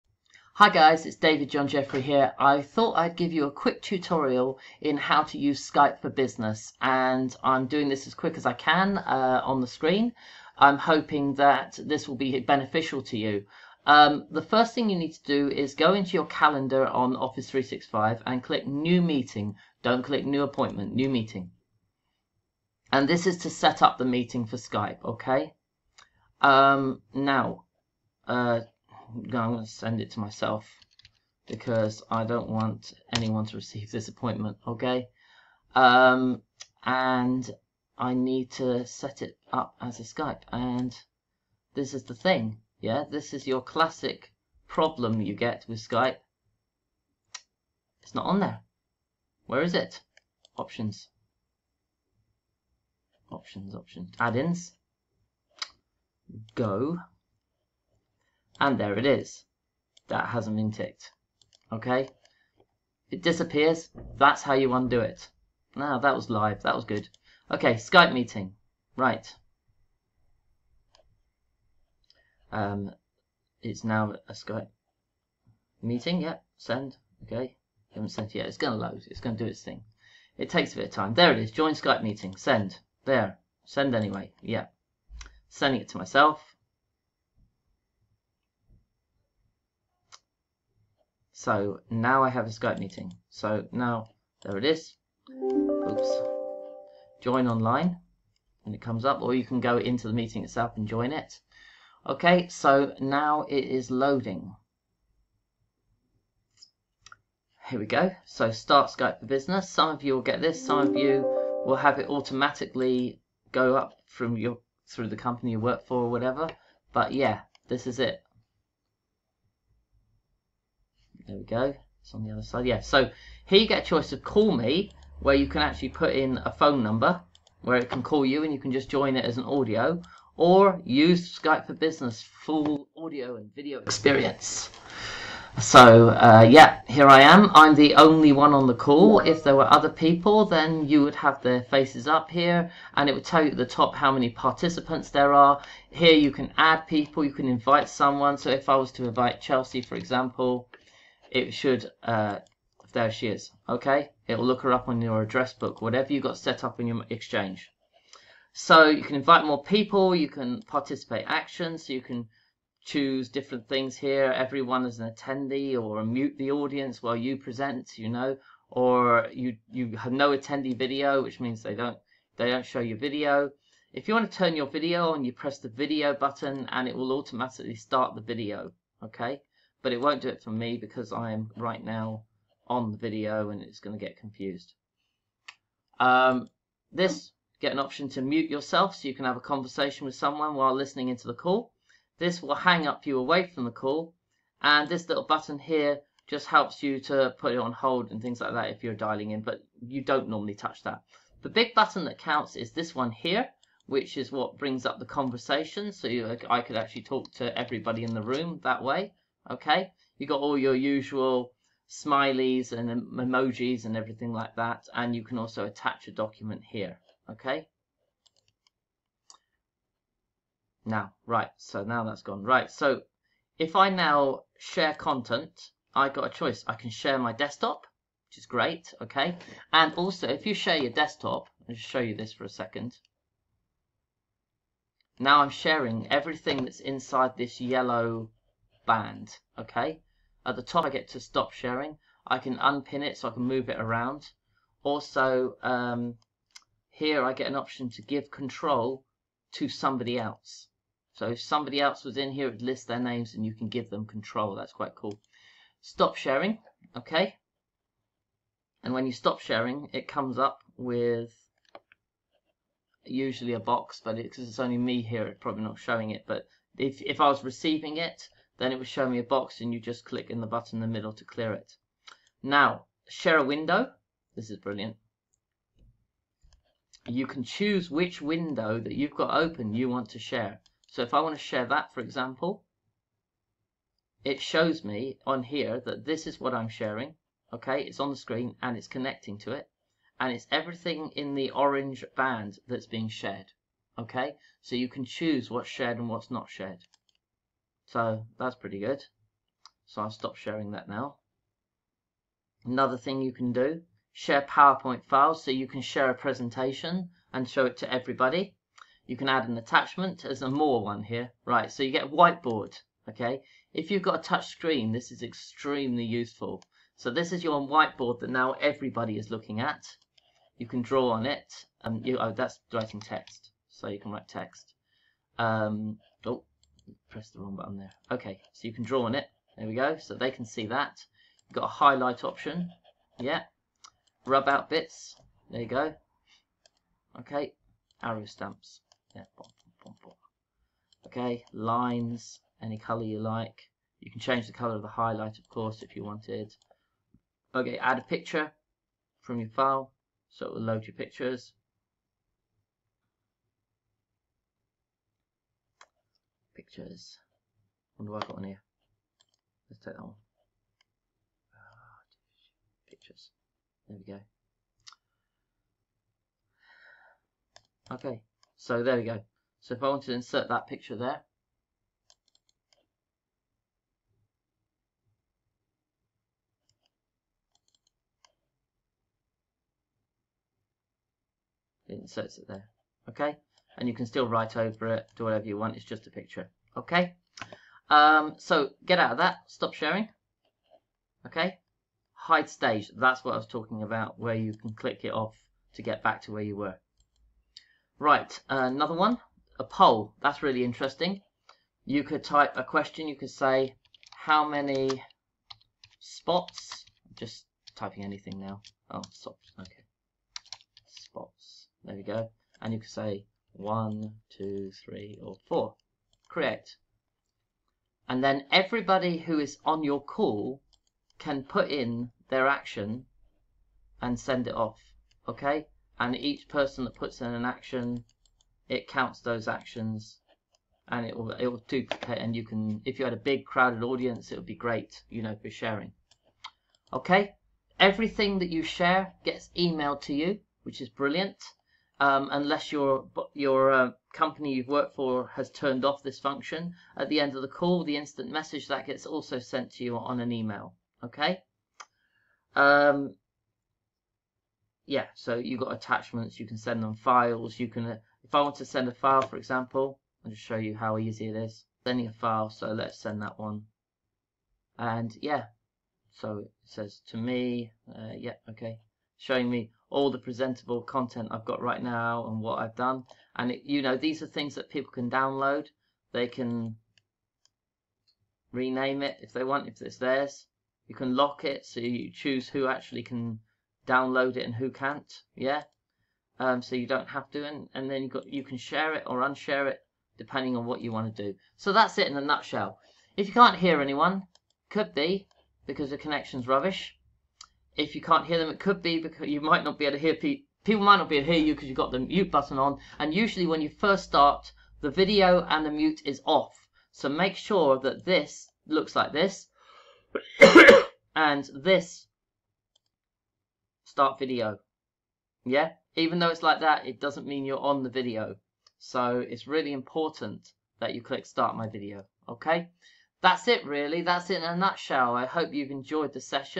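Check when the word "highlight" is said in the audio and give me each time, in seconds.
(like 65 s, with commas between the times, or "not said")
331 s, 344 s.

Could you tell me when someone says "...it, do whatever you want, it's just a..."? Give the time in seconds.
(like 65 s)
384 s.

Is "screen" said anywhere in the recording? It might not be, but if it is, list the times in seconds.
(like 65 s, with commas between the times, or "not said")
9 s, 288 s, 314 s.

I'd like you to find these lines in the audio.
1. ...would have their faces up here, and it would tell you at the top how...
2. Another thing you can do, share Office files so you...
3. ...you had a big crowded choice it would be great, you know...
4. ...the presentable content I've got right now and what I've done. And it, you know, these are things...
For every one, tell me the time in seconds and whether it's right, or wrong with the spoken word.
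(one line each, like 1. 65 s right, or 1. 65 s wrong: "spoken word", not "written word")
1. 141 s right
2. 302 s wrong: "PowerPoint", not "Office"
3. 432 s wrong: "audience", not "choice"
4. 470 s right.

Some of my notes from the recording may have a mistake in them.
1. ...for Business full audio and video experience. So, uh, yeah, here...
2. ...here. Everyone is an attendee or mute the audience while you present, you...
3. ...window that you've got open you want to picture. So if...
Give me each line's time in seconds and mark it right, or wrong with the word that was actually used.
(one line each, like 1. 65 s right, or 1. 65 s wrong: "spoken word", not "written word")
1. 131 s right
2. 163 s right
3. 278 s wrong: "share", not "picture".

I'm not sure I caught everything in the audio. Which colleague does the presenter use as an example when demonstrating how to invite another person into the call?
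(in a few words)
Chelsea.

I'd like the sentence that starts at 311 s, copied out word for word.
Right, so you get a whiteboard, okay?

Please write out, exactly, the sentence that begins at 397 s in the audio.
Right, uh, another one, a poll, that's really interesting.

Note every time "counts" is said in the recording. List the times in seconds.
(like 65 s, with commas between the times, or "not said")
202 s, 428 s.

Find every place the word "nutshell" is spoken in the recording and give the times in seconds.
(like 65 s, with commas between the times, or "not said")
492 s, 524 s.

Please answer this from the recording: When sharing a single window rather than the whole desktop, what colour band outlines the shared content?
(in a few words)
Orange.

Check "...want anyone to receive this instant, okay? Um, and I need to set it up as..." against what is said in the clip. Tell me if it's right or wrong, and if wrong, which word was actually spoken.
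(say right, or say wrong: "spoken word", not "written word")
wrong: "appointment", not "instant".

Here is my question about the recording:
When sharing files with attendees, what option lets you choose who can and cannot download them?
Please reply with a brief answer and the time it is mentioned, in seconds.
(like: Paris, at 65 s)
Lock it, at 481 s.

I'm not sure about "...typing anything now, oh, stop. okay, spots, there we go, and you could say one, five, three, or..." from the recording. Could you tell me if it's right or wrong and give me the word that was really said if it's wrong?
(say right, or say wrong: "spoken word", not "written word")
wrong: "two", not "five".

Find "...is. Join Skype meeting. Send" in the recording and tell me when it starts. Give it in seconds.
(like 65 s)
81 s.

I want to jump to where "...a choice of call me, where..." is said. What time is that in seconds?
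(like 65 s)
123 s.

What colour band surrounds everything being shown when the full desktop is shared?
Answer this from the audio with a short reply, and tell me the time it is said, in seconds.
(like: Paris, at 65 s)
Yellow, at 237 s.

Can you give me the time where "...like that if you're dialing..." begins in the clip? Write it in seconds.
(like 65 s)
198 s.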